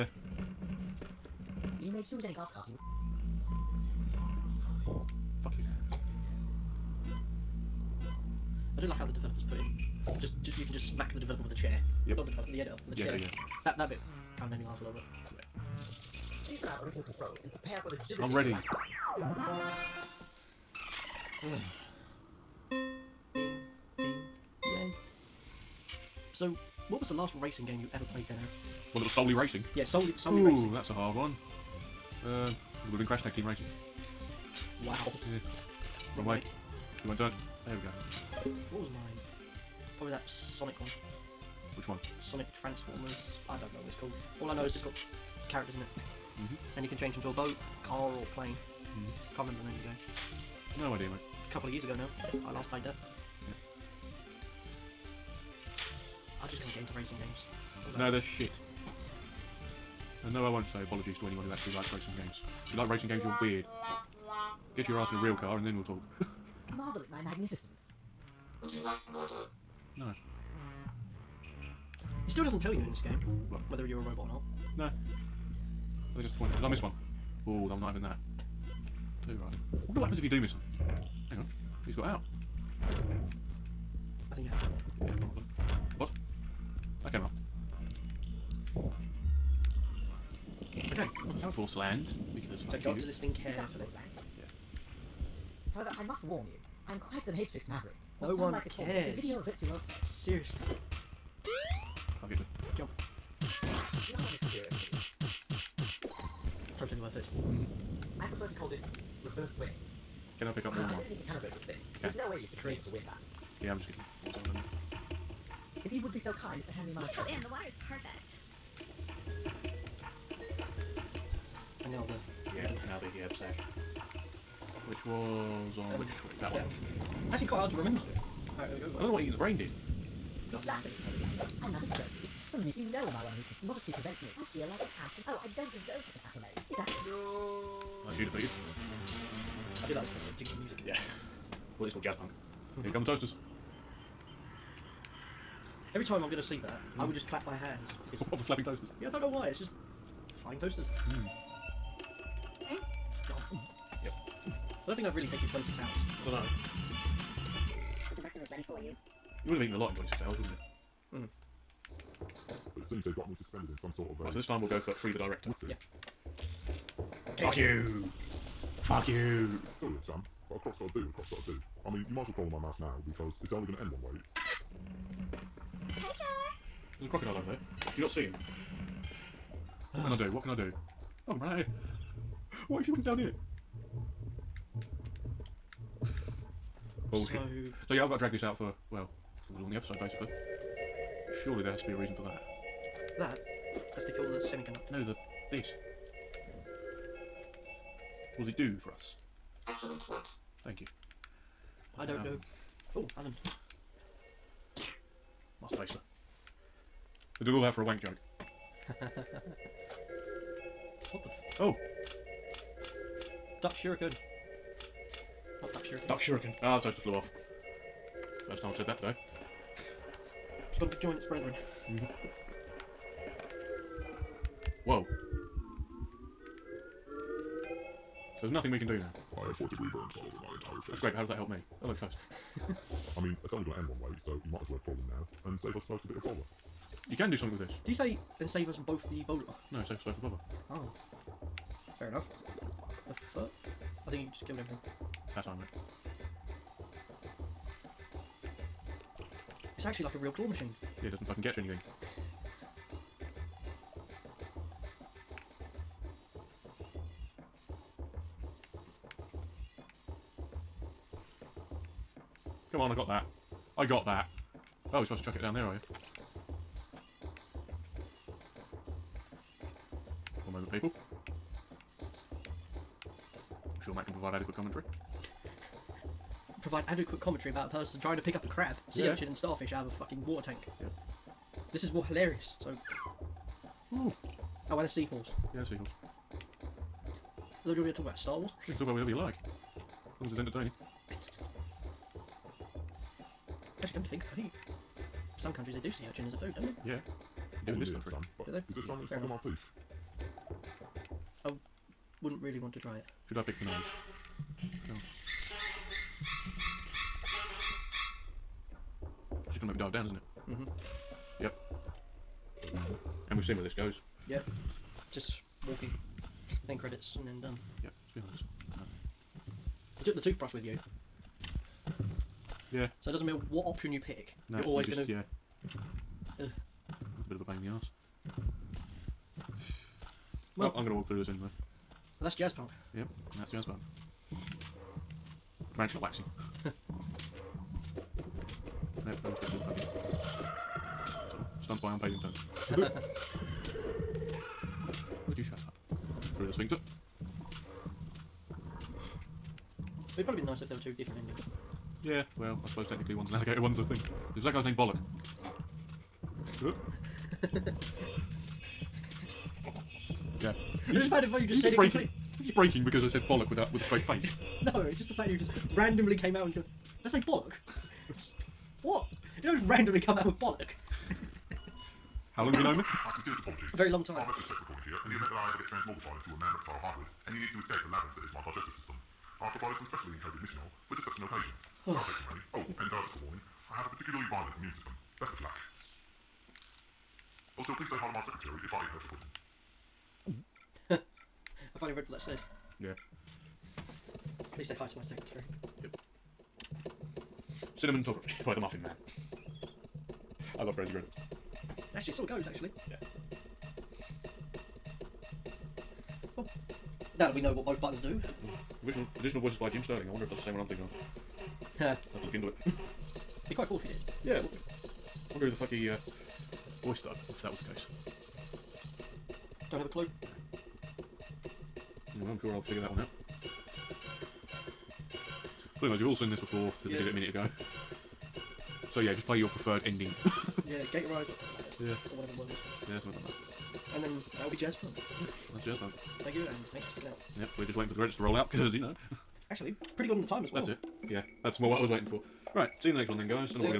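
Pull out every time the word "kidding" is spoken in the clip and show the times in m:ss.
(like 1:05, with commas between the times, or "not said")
1:53.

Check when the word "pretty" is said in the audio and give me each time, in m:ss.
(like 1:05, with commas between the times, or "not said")
7:05, 7:19.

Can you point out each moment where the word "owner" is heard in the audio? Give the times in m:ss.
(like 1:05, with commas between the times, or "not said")
not said.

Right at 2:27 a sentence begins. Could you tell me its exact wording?
I would just clap my hands.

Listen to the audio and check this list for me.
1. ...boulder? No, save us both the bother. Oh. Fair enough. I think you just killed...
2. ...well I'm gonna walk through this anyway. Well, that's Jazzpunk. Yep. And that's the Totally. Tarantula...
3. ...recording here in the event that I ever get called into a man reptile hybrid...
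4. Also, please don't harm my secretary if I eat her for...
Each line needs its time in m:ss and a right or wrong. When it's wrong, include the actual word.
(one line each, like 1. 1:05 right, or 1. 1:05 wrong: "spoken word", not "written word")
1. 3:59 right
2. 5:30 wrong: "Earthbound", not "Totally"
3. 6:14 wrong: "transmogrified", not "called"
4. 6:27 right.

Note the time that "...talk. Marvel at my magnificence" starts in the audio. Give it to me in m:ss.
1:05.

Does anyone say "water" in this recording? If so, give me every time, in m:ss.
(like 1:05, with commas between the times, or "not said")
1:57, 4:40.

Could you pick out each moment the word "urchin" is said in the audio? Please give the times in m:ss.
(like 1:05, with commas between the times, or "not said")
4:39, 4:56.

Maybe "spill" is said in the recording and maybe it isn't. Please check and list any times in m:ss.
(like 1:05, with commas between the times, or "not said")
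not said.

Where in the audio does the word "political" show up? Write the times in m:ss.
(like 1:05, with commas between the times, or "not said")
not said.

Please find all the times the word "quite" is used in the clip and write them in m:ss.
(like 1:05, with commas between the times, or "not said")
1:36, 2:07, 6:53.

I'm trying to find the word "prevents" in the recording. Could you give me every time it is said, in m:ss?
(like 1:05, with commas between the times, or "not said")
2:13.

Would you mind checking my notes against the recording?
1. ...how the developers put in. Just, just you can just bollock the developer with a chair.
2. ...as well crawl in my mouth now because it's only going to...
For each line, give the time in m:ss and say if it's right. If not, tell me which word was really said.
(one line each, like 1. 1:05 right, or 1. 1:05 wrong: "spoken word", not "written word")
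1. 0:08 wrong: "smack", not "bollock"
2. 2:52 right.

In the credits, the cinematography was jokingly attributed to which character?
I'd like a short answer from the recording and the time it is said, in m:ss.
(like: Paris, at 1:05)
The Muffin Man, at 6:38.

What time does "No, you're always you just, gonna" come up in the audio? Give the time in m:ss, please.
5:24.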